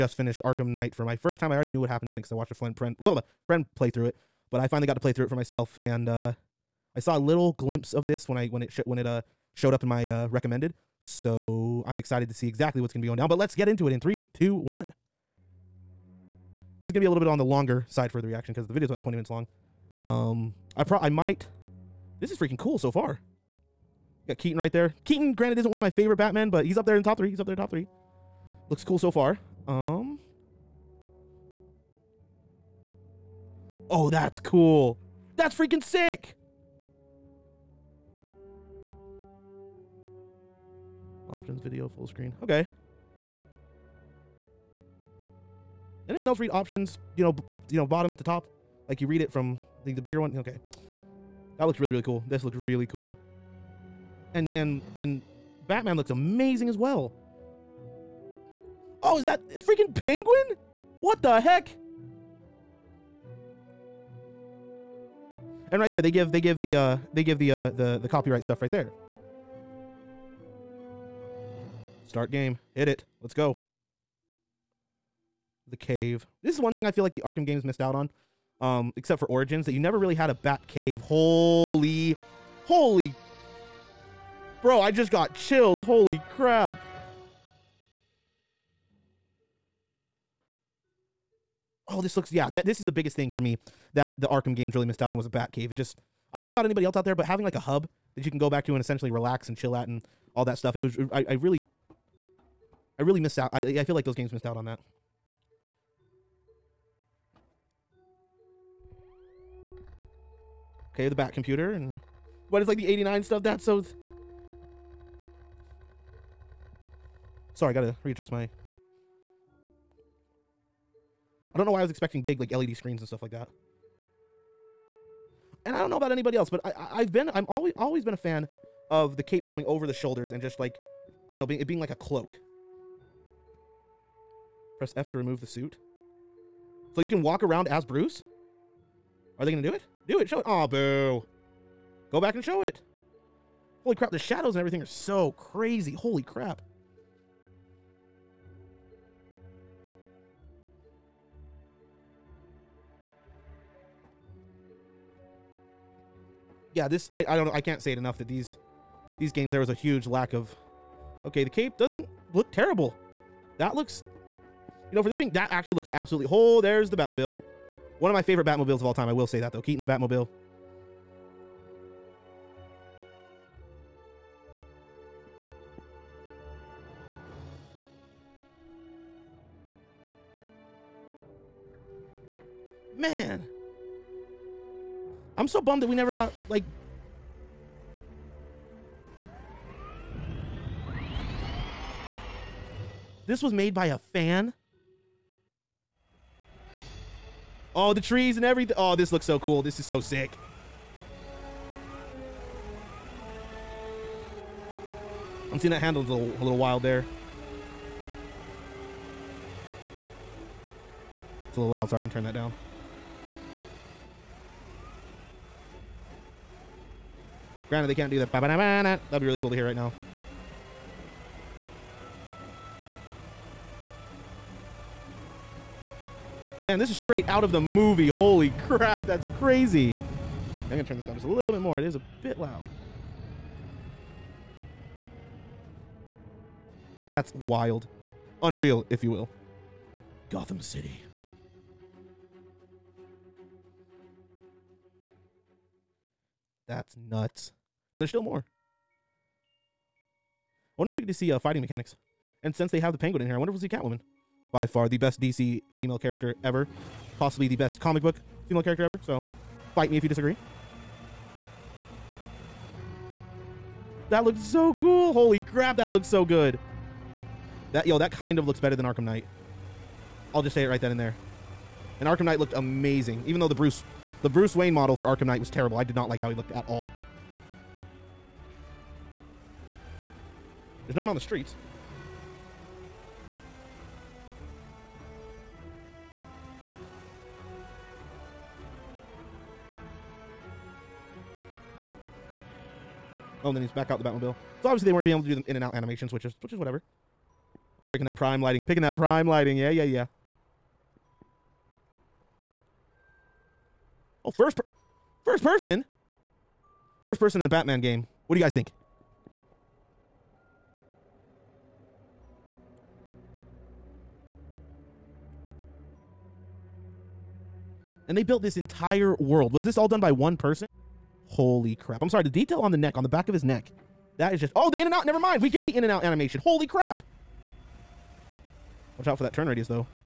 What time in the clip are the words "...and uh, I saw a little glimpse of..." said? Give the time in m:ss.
0:05.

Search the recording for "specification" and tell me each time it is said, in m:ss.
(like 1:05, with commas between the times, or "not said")
not said.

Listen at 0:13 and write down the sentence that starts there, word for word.
But let's get into it in three, two, one.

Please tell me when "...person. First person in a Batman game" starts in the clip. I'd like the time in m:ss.
5:05.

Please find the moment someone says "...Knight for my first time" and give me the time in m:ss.
0:00.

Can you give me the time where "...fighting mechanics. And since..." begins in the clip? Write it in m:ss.
4:11.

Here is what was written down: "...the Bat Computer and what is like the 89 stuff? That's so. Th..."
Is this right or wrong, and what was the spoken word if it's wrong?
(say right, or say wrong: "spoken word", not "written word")
right.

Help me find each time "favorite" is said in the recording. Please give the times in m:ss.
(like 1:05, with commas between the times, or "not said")
0:25, 2:48.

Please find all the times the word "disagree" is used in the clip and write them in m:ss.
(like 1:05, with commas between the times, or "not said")
4:20.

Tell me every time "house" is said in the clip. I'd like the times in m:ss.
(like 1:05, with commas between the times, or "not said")
not said.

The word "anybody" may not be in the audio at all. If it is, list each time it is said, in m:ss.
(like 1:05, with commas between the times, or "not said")
1:36, 2:06.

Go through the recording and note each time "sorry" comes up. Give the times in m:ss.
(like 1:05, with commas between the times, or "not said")
1:57, 5:22.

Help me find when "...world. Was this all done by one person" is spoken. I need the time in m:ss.
5:19.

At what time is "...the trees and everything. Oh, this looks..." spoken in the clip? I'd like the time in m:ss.
3:17.